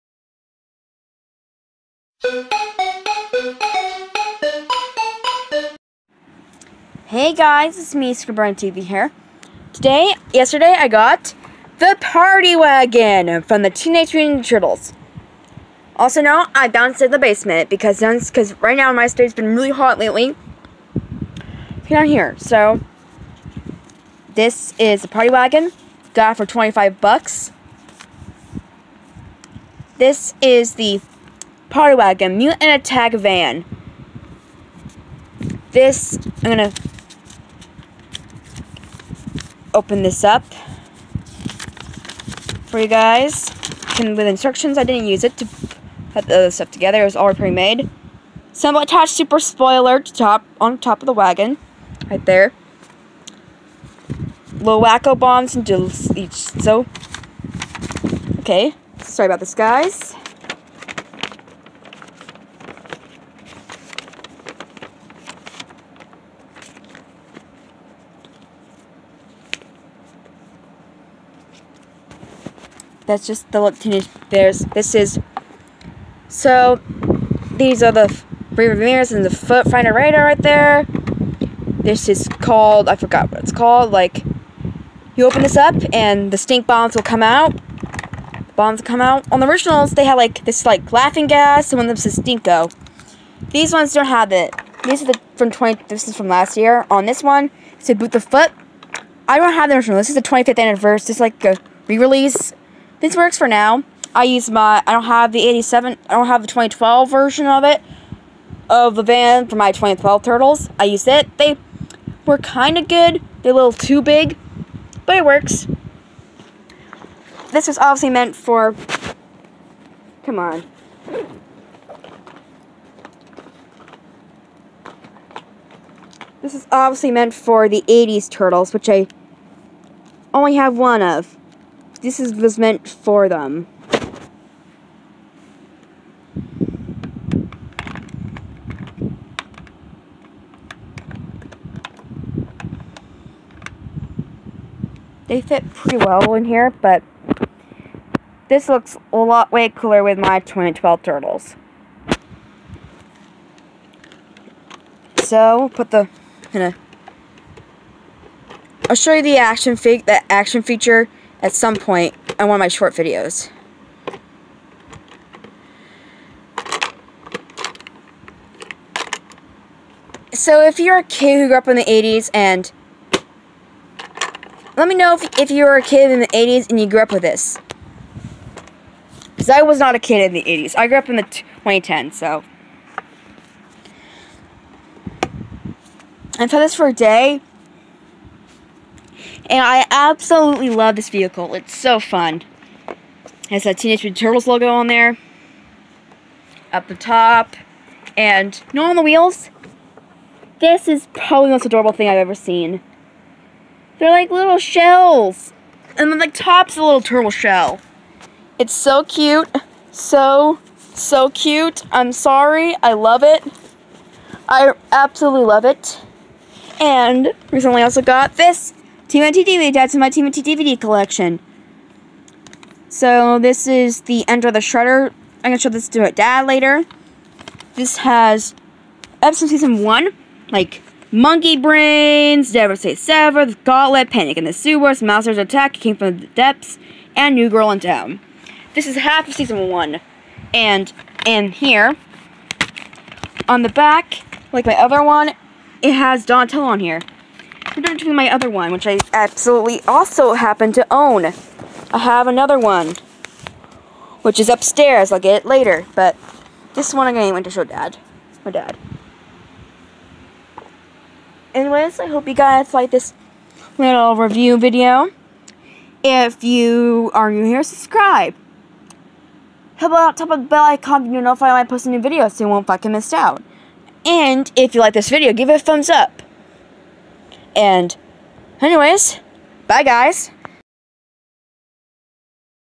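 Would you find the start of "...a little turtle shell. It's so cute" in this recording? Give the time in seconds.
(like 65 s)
206 s.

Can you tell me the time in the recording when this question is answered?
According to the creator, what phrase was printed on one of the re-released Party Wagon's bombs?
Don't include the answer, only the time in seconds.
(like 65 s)
97 s.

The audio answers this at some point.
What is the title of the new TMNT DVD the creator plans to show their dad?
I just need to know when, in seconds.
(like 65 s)
224 s.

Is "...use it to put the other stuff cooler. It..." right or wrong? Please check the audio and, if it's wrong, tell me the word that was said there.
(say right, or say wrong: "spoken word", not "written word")
wrong: "together", not "cooler".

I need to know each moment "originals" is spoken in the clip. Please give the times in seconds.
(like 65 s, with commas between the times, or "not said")
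89 s, 99 s.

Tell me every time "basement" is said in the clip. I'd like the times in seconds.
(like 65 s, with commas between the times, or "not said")
17 s.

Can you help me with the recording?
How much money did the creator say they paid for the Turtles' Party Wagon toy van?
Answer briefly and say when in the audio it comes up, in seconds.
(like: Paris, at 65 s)
$25, at 26 s.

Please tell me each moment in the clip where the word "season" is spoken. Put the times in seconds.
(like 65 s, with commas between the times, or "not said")
229 s, 239 s.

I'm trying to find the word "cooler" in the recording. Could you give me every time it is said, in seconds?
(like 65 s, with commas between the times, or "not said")
149 s.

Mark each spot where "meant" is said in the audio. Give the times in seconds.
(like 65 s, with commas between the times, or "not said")
118 s, 127 s, 132 s.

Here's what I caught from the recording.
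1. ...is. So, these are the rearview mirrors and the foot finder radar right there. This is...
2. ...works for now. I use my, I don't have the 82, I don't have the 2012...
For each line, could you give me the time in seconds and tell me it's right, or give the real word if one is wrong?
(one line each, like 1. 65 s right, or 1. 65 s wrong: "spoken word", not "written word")
1. 74 s right
2. 103 s wrong: "87", not "82".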